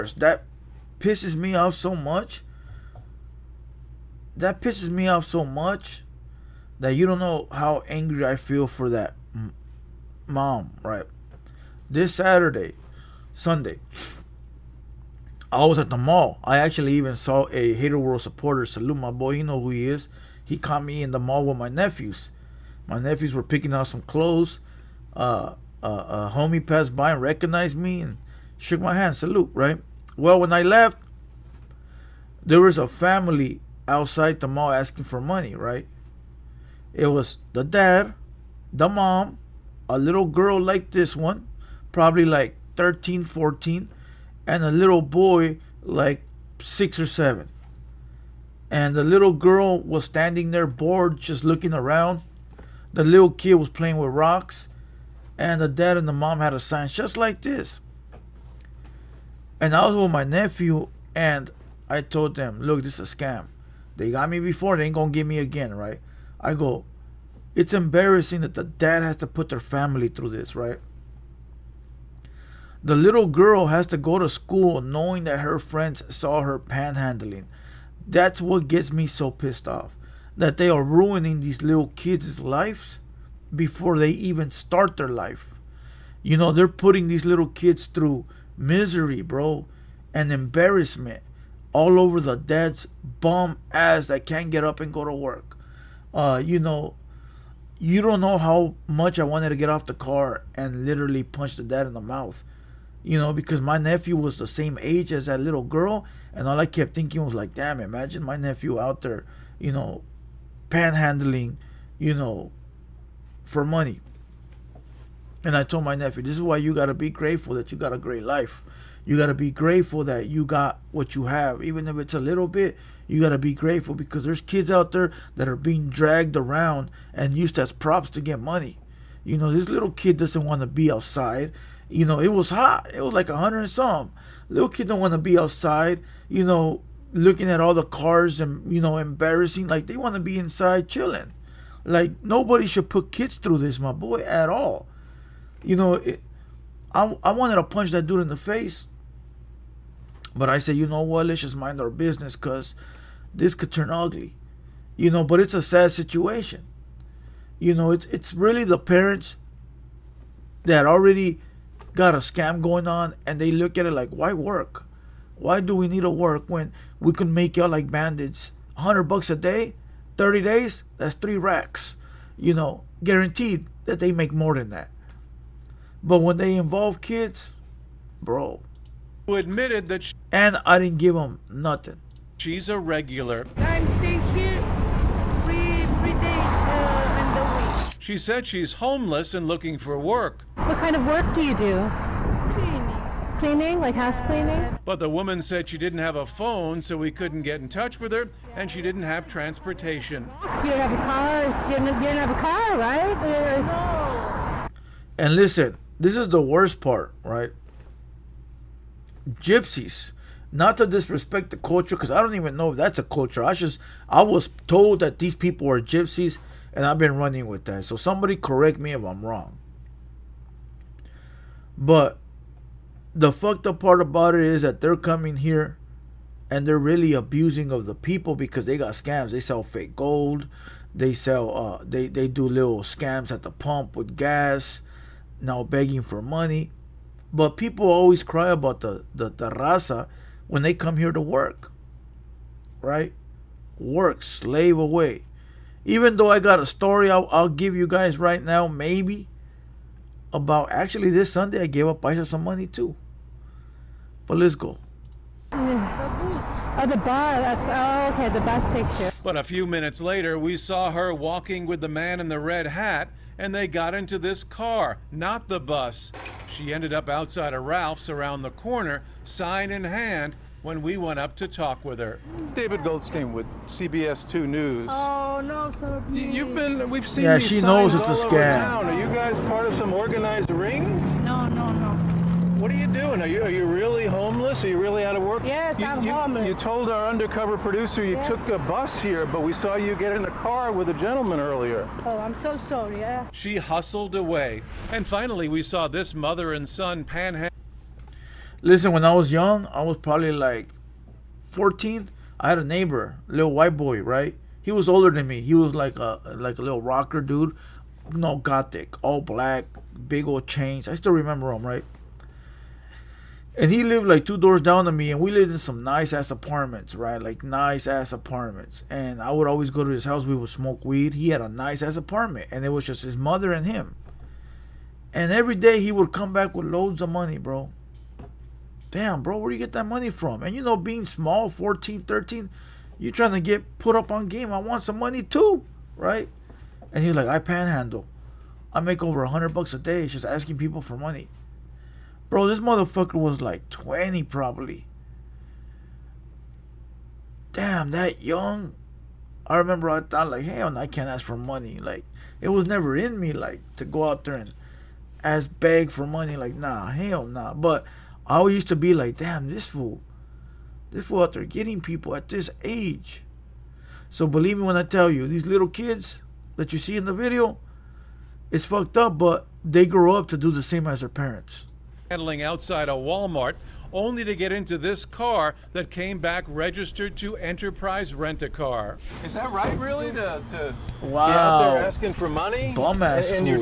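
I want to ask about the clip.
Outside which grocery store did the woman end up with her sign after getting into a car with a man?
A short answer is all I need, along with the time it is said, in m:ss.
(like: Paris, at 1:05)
Ralph's, at 4:27.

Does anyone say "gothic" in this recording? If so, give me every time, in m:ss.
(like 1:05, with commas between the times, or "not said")
5:08.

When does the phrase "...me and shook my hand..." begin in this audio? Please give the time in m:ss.
0:27.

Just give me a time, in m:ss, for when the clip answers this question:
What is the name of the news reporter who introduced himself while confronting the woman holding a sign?
4:32.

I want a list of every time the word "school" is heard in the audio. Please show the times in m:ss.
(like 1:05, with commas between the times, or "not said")
1:14.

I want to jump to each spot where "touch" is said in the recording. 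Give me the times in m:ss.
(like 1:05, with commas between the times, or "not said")
3:17.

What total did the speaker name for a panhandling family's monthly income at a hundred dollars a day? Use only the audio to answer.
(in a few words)
3 racks.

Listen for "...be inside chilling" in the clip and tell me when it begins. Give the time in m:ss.
2:20.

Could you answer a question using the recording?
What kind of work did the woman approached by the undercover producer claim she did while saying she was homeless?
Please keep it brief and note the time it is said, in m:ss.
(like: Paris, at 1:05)
House cleaning, at 3:13.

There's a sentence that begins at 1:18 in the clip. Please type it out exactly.
That's what gets me so pissed off.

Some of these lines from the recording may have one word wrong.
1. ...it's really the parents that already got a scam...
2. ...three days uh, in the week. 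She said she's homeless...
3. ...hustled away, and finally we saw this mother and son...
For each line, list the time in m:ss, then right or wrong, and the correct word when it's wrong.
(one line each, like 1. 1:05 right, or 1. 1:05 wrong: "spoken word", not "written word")
1. 2:38 right
2. 3:05 right
3. 4:53 right.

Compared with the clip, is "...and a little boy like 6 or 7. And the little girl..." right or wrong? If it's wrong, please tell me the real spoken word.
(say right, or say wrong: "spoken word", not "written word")
right.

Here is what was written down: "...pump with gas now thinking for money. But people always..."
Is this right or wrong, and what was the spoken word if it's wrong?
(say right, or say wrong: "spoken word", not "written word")
wrong: "begging", not "thinking".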